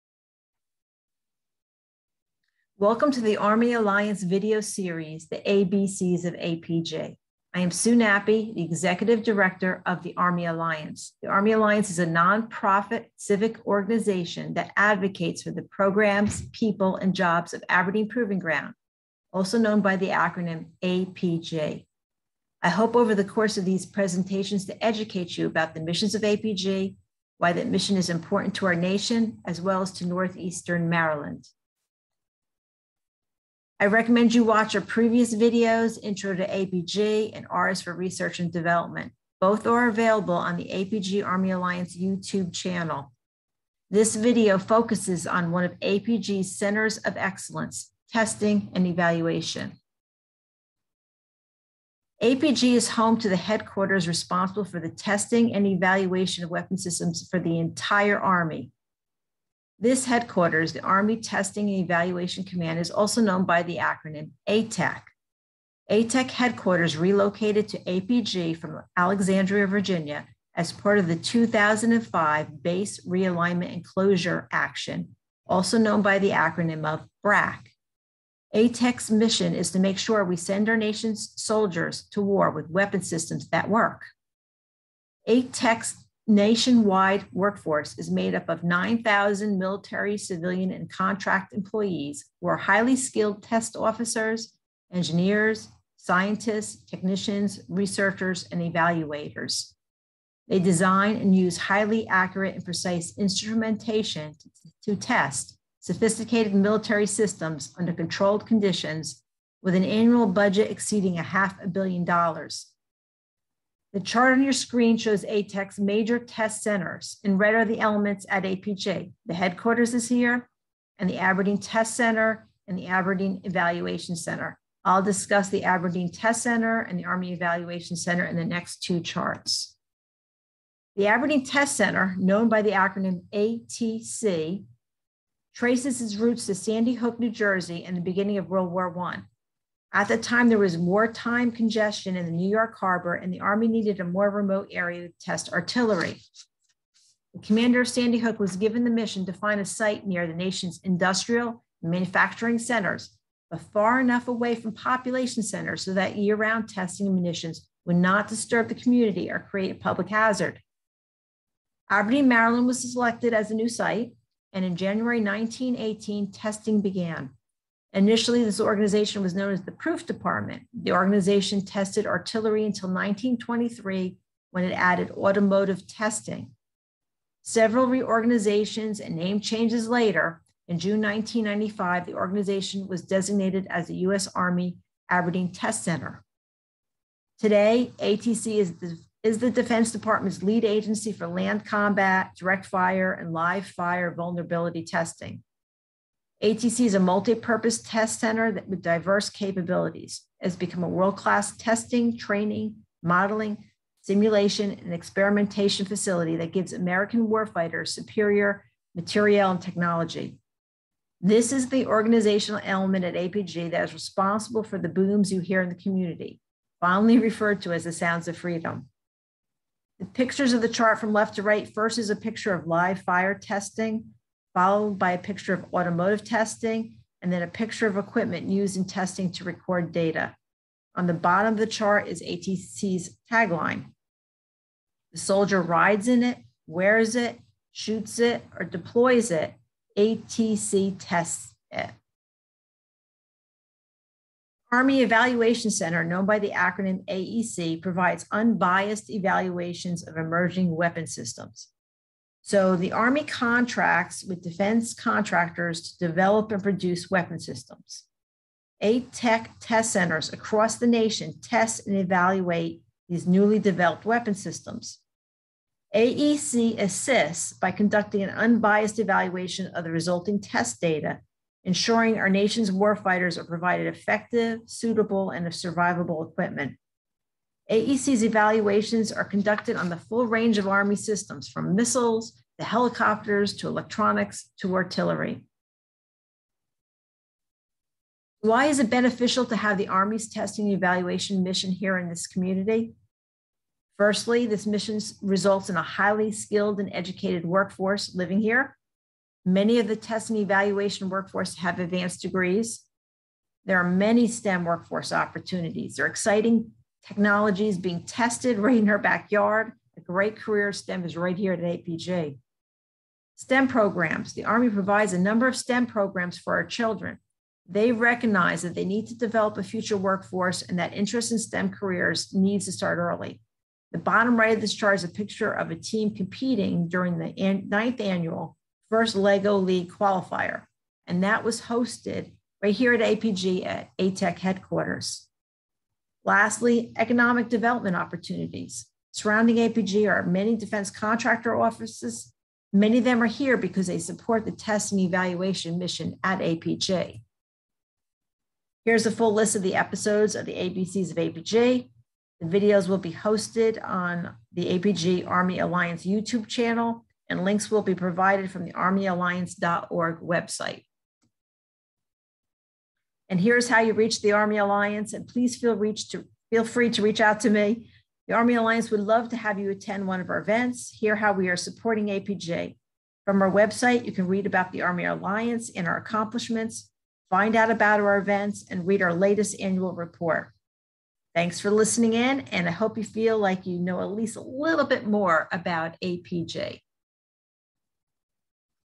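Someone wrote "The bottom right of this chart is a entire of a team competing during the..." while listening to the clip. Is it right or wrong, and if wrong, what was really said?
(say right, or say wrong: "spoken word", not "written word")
wrong: "picture", not "entire".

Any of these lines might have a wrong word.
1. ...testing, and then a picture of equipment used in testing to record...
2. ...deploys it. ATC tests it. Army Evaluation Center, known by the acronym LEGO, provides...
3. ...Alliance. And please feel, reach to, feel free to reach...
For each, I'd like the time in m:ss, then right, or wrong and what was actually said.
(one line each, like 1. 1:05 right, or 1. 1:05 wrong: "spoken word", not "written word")
1. 3:46 right
2. 3:58 wrong: "AEC", not "LEGO"
3. 6:04 right.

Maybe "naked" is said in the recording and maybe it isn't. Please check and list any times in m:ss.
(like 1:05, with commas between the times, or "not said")
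not said.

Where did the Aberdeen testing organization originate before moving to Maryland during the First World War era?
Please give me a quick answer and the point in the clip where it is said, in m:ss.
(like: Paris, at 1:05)
Sandy Hook, New Jersey, at 2:16.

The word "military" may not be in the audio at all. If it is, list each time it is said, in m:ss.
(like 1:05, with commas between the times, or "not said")
1:29, 1:46.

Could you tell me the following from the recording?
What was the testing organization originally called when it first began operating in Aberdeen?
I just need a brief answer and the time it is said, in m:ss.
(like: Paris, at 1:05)
Proof Department, at 2:49.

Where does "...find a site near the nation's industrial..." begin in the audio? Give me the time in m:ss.
2:29.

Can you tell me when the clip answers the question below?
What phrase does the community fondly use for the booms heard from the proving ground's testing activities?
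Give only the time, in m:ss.
3:37.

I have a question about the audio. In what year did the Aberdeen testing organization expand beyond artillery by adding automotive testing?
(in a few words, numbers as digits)
1923.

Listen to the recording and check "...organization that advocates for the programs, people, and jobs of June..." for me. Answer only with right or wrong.
wrong.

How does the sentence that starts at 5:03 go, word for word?
There are many STEM workforce opportunities.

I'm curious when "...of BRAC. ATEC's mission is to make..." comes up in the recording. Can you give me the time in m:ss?
1:16.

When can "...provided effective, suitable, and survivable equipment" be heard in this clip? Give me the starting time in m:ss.
4:33.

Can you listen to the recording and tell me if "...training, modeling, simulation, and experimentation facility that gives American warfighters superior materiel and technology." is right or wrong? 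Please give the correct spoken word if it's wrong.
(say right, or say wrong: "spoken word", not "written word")
right.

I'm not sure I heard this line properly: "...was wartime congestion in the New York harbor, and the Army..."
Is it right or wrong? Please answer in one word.
right.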